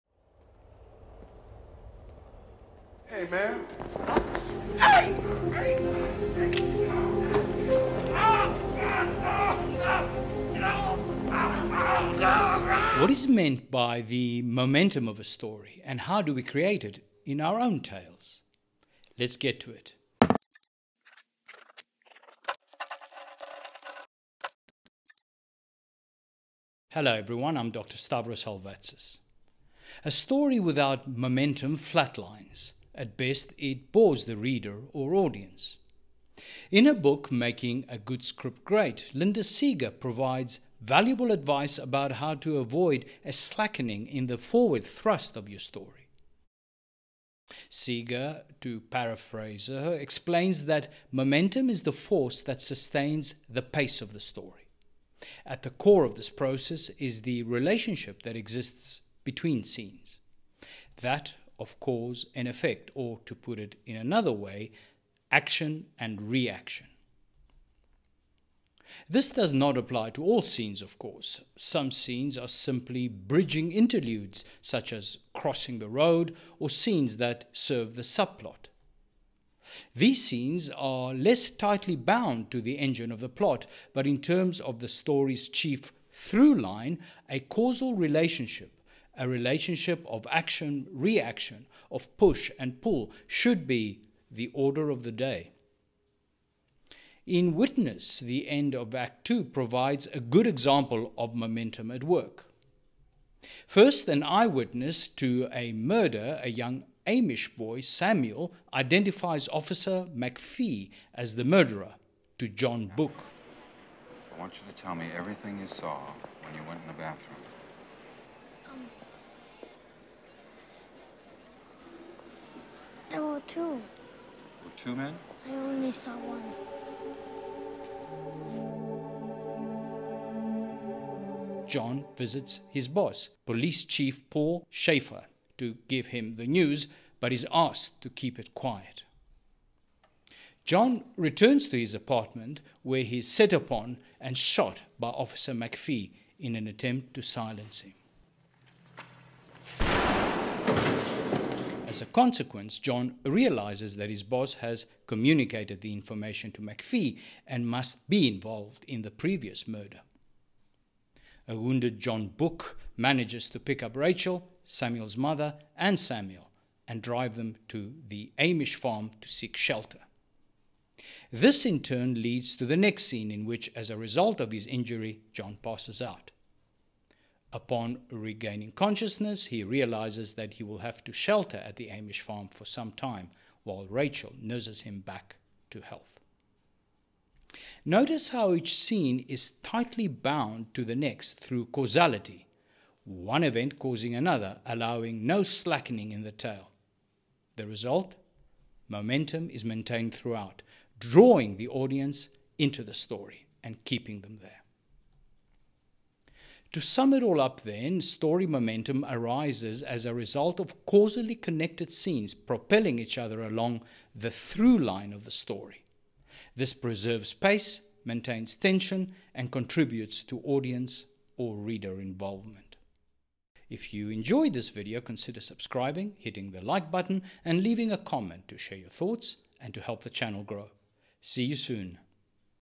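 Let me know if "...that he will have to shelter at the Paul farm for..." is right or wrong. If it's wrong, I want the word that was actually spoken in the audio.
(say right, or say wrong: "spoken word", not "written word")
wrong: "Amish", not "Paul".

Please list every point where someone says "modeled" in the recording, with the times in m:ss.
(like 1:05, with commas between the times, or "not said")
not said.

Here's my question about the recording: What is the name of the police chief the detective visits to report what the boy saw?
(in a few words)
Paul Schaeffer.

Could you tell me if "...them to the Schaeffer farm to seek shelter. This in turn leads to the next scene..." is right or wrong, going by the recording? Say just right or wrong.
wrong.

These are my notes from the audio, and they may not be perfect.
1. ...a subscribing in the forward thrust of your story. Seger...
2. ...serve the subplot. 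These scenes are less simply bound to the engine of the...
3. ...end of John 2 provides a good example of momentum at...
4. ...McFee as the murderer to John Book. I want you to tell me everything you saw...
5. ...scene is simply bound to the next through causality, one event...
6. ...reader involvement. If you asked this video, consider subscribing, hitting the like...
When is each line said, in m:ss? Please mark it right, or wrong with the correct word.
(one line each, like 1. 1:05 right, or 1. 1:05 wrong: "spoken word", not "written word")
1. 0:43 wrong: "slackening", not "subscribing"
2. 1:17 wrong: "tightly", not "simply"
3. 1:38 wrong: "Act", not "John"
4. 1:50 right
5. 3:08 wrong: "tightly", not "simply"
6. 3:41 wrong: "enjoyed", not "asked".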